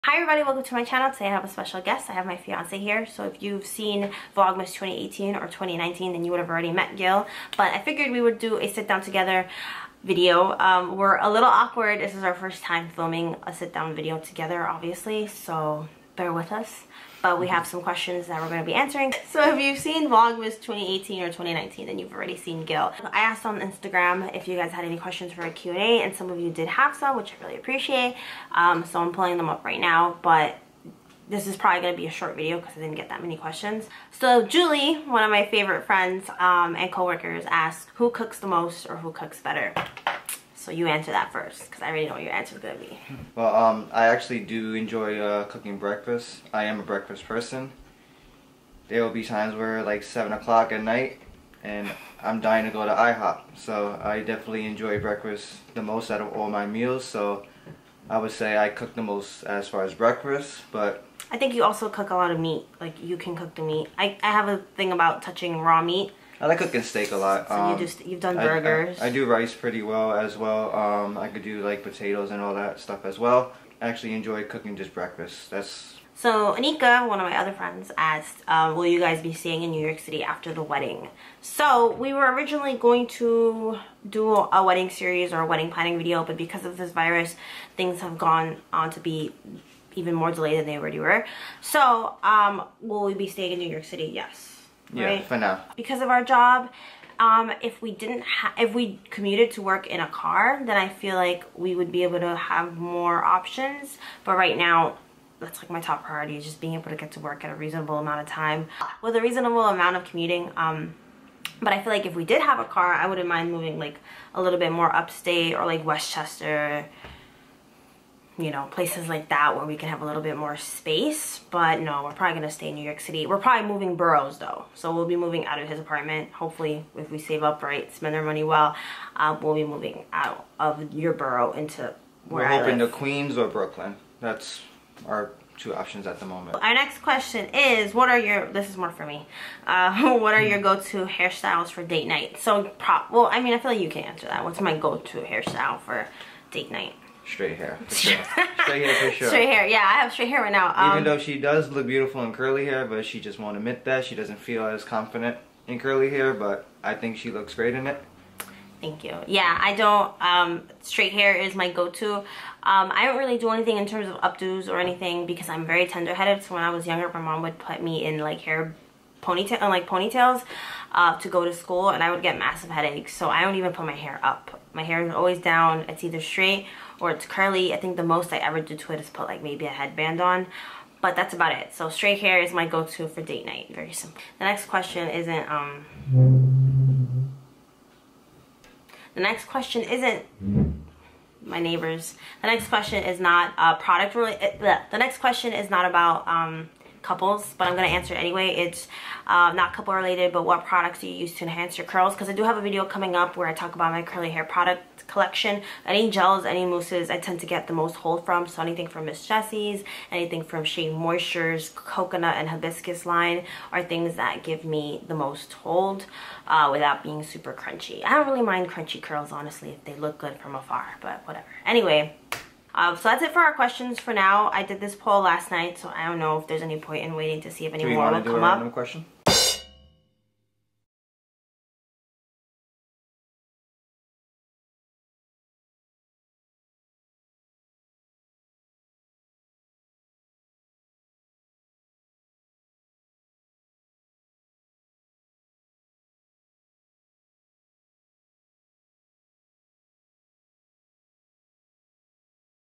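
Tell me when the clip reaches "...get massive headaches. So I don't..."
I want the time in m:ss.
2:52.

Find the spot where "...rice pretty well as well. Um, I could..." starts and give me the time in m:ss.
1:09.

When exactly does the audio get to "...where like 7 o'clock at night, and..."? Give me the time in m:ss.
0:49.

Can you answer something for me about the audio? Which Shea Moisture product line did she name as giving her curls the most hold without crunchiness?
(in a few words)
coconut and hibiscus.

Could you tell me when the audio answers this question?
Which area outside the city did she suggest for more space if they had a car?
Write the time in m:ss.
1:55.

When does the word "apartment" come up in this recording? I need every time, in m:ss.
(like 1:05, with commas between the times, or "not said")
2:05.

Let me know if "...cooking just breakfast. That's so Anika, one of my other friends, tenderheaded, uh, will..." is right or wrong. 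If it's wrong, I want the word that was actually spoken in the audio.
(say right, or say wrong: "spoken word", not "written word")
wrong: "asked", not "tenderheaded".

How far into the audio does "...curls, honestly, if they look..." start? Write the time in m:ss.
3:39.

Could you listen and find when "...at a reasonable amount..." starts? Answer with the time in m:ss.
1:47.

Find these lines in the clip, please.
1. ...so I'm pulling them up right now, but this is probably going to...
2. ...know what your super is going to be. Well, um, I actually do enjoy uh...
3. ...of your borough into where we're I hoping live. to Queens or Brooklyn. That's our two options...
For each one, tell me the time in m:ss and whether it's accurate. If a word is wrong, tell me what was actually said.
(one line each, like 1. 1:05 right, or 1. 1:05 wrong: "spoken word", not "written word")
1. 0:28 right
2. 0:42 wrong: "answer", not "super"
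3. 2:10 right.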